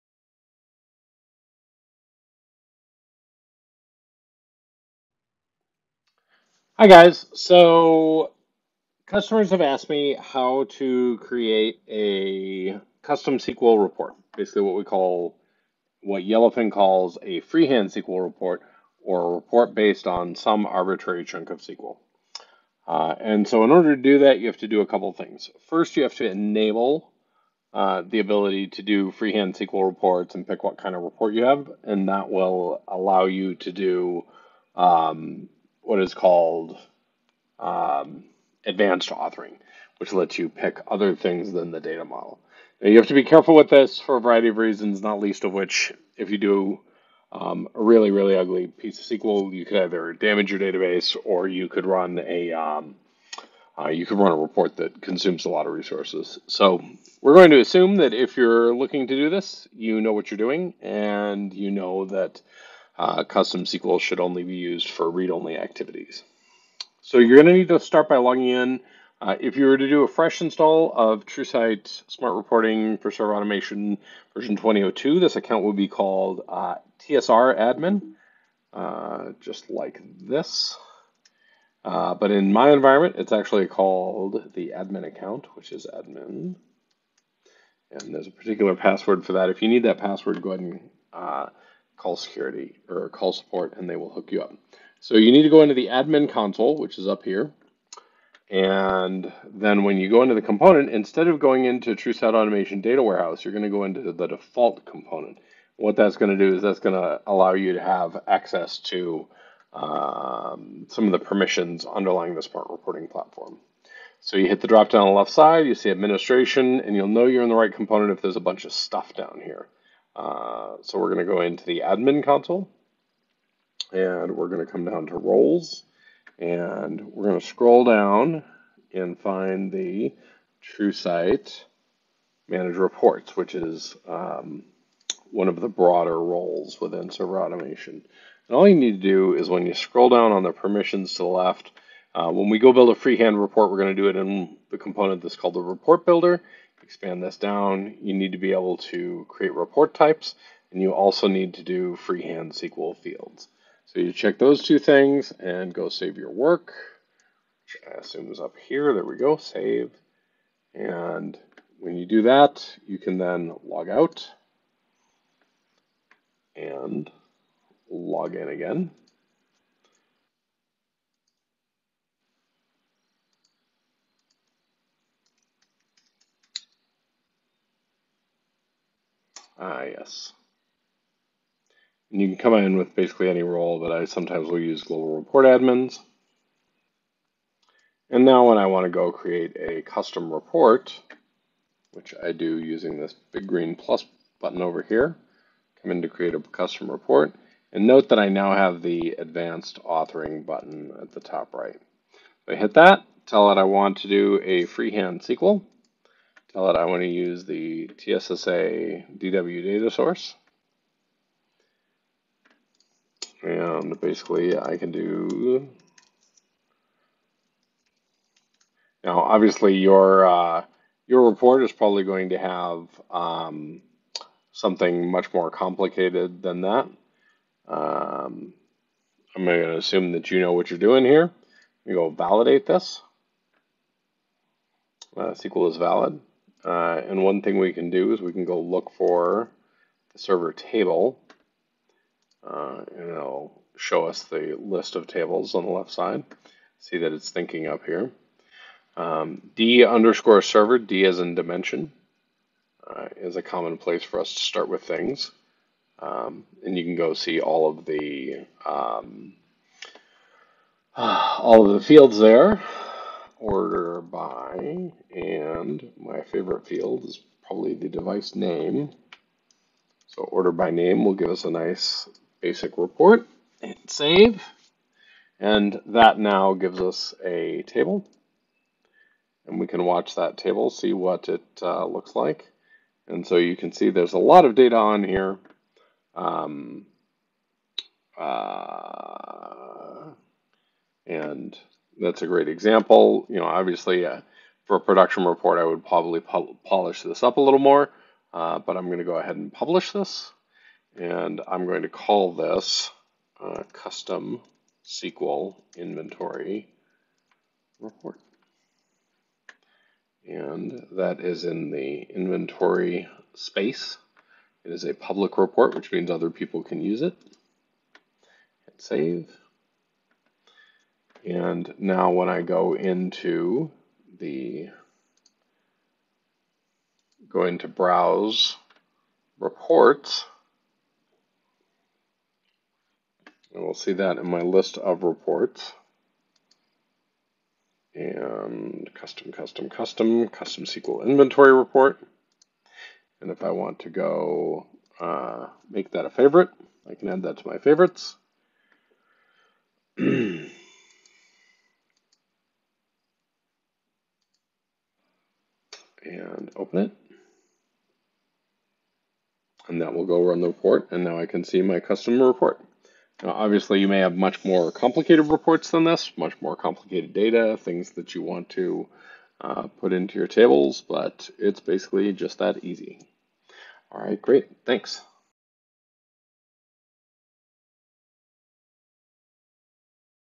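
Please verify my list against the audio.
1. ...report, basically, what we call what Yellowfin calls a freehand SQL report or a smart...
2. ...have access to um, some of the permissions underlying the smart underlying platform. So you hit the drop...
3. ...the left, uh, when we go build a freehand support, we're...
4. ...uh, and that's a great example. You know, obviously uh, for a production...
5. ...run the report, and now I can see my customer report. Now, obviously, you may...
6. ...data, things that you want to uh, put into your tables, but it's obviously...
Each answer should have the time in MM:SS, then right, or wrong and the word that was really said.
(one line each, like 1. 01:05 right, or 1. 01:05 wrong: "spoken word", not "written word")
1. 00:13 wrong: "report", not "smart"
2. 01:47 wrong: "reporting", not "underlying"
3. 02:21 wrong: "report", not "support"
4. 04:48 right
5. 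06:00 right
6. 06:07 wrong: "basically", not "obviously".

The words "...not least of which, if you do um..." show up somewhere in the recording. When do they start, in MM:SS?
00:45.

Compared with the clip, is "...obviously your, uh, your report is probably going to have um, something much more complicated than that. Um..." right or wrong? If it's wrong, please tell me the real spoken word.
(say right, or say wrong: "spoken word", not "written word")
right.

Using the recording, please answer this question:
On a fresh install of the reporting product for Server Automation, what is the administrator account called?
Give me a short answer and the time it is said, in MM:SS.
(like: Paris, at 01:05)
TSR Admin, at 01:17.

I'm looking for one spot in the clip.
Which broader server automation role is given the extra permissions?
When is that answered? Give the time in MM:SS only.
02:10.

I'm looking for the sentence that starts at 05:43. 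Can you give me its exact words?
And if I want to go uh, make that a favorite, I can add that to my favorites.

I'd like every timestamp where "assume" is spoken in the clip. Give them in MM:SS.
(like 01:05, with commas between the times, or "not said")
00:57, 02:37, 03:49.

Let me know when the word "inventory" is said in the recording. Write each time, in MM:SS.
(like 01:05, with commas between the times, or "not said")
05:05, 05:12, 05:41.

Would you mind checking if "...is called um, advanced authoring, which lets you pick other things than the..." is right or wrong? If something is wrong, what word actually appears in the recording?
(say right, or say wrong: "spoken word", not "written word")
right.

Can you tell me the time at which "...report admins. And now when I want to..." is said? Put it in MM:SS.
03:05.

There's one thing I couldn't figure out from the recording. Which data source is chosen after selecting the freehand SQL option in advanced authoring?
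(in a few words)
TSSA DW.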